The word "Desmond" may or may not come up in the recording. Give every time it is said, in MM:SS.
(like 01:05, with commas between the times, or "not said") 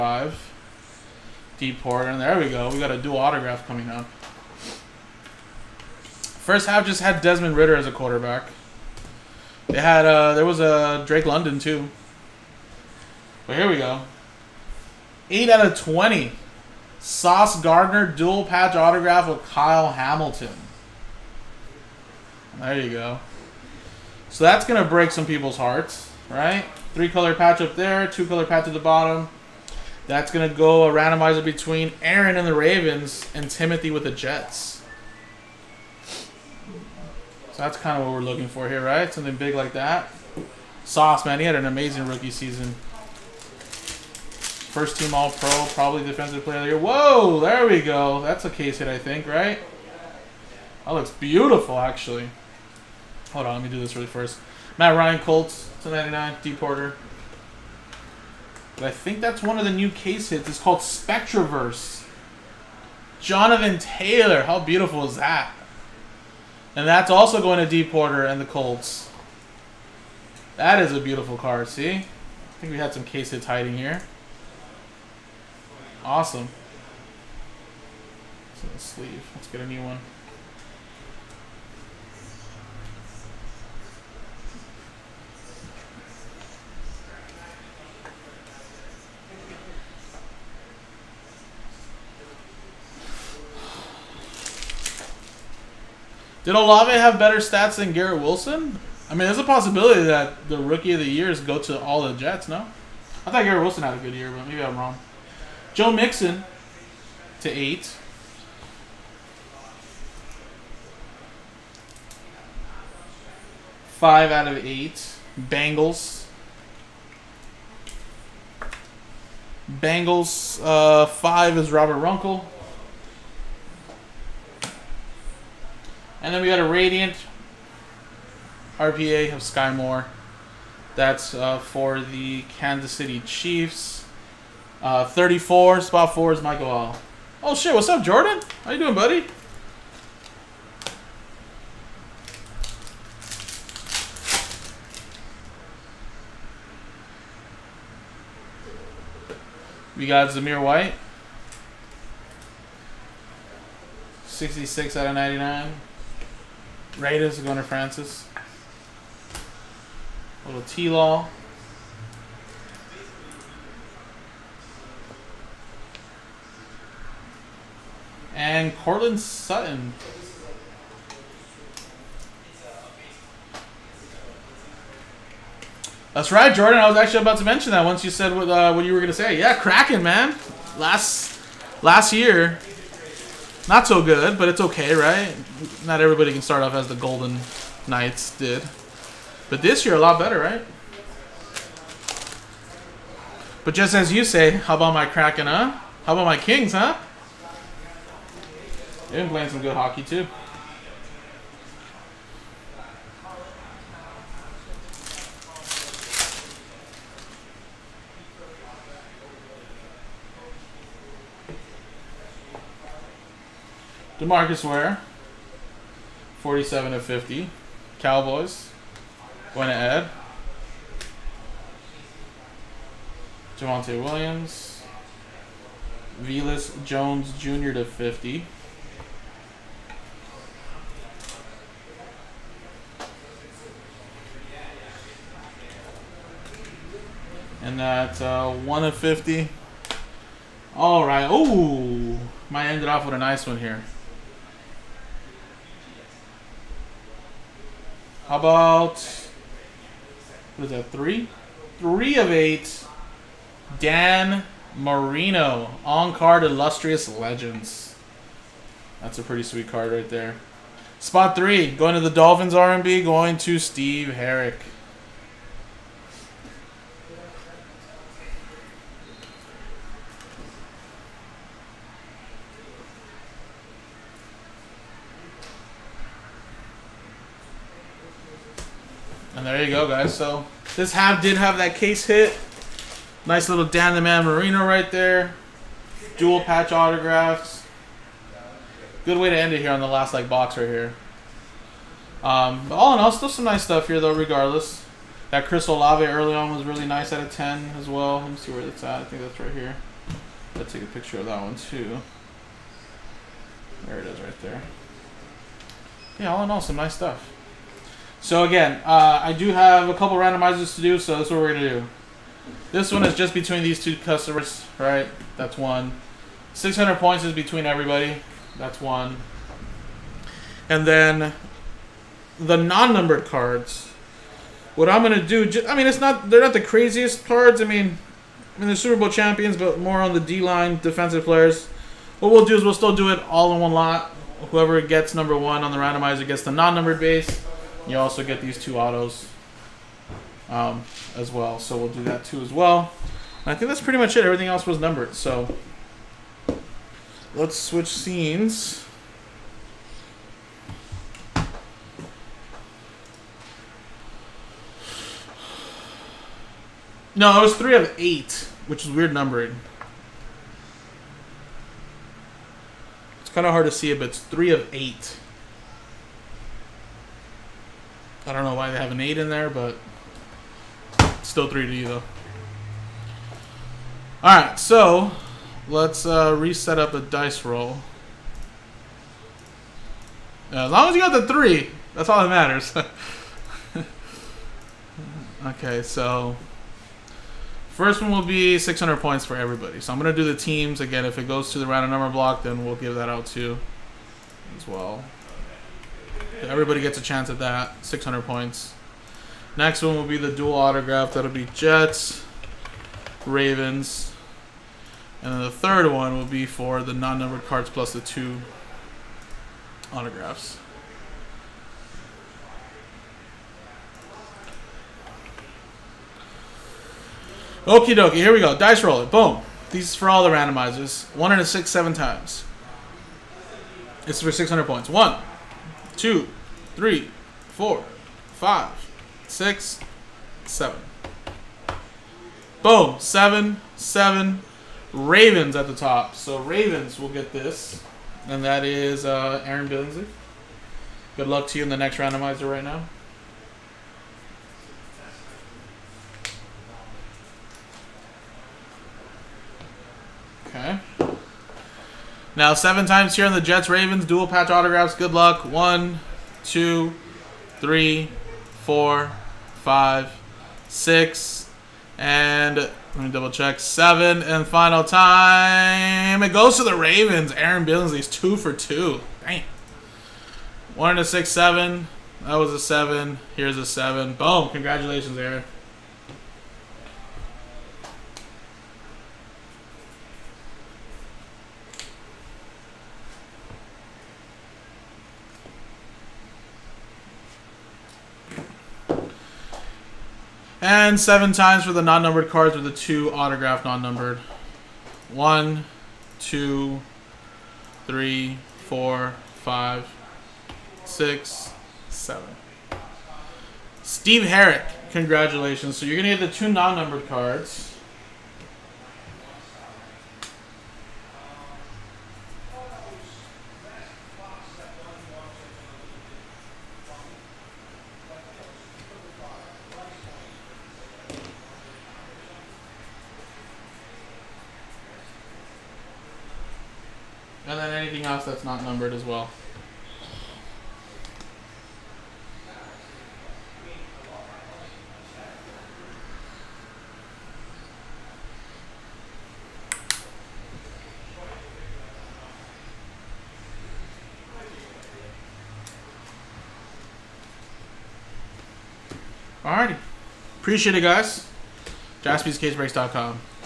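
00:07.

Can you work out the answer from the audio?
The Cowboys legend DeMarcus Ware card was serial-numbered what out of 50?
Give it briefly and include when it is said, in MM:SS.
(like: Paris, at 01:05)
47, at 03:36.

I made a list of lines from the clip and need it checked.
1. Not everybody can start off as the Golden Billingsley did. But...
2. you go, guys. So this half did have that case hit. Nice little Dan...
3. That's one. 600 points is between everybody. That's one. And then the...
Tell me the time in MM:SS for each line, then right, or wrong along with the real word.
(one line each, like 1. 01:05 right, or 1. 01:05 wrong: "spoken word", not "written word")
1. 03:05 wrong: "Knights", not "Billingsley"
2. 04:39 right
3. 05:15 right.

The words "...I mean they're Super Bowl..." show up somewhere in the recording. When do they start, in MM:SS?
05:28.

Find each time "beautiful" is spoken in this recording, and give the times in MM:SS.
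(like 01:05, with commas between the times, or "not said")
00:51, 01:04, 01:10.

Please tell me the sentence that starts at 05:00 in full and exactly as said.
Let's take a picture of that one too.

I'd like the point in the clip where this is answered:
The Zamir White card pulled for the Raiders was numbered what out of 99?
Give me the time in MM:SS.
02:34.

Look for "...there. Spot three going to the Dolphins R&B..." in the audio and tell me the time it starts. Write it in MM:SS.
04:20.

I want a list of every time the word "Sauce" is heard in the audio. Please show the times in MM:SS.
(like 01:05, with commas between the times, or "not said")
00:16, 00:40.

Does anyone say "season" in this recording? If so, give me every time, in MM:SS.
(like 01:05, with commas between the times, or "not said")
00:42.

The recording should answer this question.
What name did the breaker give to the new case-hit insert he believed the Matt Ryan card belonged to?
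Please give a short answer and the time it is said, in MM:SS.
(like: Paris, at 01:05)
Spectroverse, at 01:00.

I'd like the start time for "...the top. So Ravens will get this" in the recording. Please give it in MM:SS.
07:15.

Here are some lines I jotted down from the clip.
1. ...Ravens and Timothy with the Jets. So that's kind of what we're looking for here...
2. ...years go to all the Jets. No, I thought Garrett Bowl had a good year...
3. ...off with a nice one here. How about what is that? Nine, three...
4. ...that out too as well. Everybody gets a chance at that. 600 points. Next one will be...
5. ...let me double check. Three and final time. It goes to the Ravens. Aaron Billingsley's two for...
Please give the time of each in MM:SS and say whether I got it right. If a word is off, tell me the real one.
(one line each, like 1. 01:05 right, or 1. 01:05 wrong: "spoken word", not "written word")
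1. 00:32 right
2. 01:41 wrong: "Wilson", not "Bowl"
3. 04:02 wrong: "Three", not "Nine"
4. 06:32 right
5. 07:42 wrong: "Seven", not "Three".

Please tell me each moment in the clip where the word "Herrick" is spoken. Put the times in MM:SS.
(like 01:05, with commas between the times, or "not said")
04:24, 08:24.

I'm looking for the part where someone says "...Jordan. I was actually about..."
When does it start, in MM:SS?
02:56.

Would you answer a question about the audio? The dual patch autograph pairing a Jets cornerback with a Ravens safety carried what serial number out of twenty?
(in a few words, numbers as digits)
8.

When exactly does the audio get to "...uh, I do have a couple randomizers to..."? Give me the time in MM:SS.
05:08.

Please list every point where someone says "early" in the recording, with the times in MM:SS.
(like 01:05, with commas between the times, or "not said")
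04:56.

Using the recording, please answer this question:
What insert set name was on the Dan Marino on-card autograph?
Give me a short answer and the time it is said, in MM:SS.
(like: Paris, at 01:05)
Illustrious Legends, at 04:16.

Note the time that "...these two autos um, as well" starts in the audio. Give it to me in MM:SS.
05:38.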